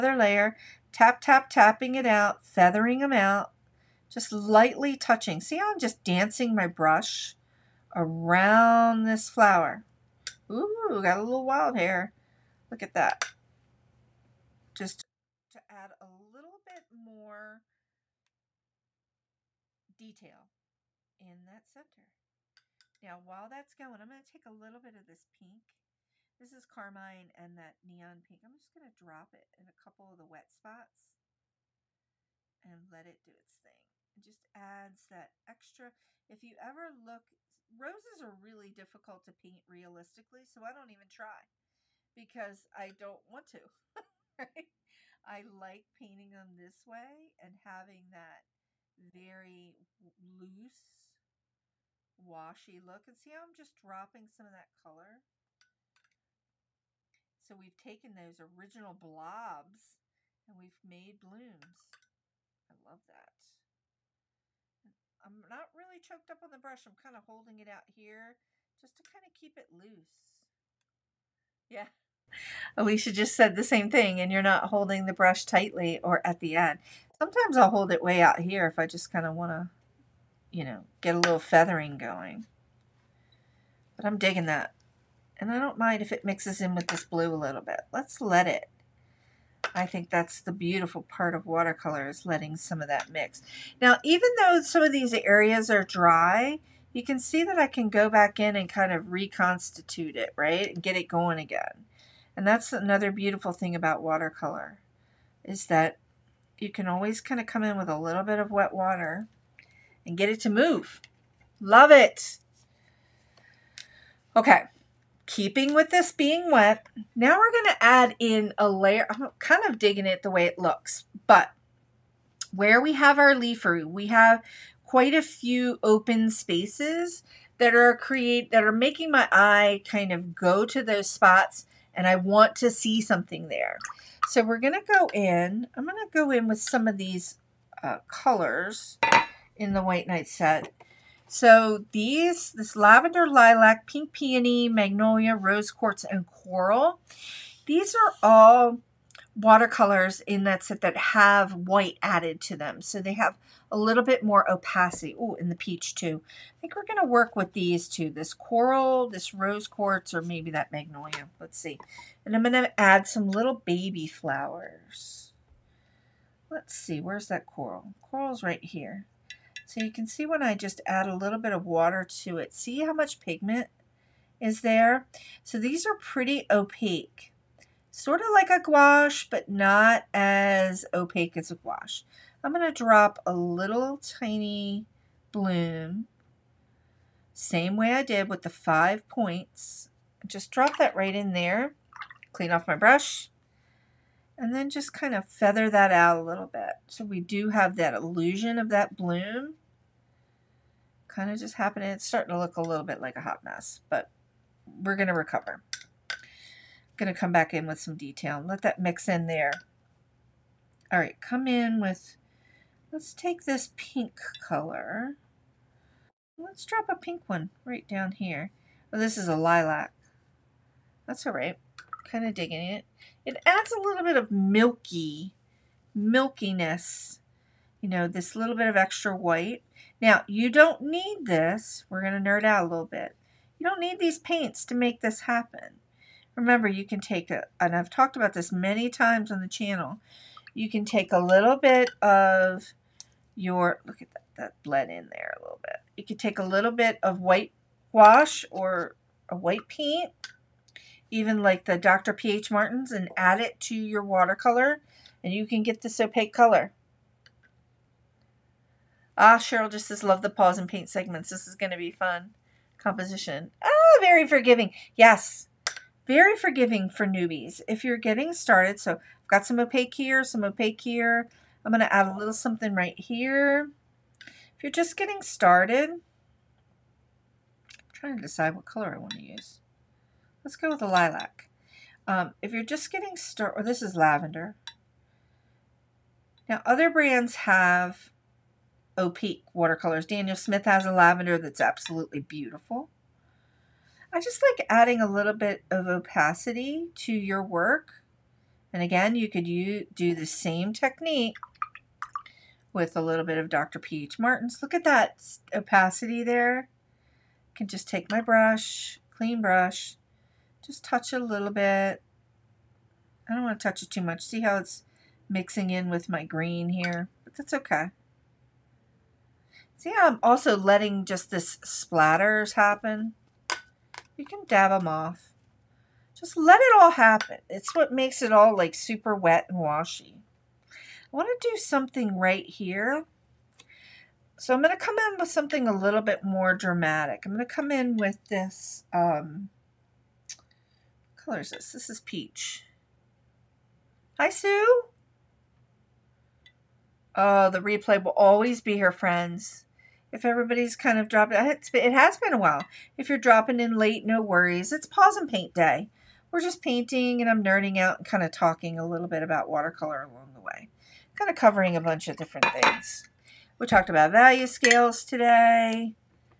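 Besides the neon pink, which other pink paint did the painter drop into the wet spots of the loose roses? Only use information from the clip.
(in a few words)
Carmine.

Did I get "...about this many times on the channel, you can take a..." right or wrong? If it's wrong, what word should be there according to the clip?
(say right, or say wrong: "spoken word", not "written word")
right.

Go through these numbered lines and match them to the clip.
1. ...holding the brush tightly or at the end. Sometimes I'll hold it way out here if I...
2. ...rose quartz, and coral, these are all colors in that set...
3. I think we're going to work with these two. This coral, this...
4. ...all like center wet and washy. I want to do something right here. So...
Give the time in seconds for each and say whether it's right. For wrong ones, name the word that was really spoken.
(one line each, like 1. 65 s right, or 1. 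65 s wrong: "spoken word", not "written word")
1. 74 s right
2. 145 s wrong: "watercolors", not "colors"
3. 156 s right
4. 328 s wrong: "super", not "center".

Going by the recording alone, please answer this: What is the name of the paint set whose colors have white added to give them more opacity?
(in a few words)
White Night.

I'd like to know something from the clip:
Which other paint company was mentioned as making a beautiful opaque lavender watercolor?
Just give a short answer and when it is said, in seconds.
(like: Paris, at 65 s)
Daniel Smith, at 290 s.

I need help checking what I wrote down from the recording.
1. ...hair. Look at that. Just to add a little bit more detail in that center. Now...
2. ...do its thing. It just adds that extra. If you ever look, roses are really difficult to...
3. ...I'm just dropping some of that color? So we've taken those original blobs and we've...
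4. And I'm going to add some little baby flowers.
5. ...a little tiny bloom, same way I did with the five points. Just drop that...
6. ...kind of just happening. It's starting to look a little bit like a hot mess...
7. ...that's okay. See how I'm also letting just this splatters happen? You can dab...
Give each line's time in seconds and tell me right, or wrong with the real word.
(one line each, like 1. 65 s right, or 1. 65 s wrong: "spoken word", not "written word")
1. 11 s right
2. 33 s right
3. 53 s right
4. 162 s right
5. 183 s right
6. 201 s right
7. 317 s right.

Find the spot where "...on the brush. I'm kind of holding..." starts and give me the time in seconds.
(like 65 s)
66 s.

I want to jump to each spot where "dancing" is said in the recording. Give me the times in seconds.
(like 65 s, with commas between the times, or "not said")
6 s.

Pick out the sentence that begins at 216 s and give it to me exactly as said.
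Let's drop a pink one right down here.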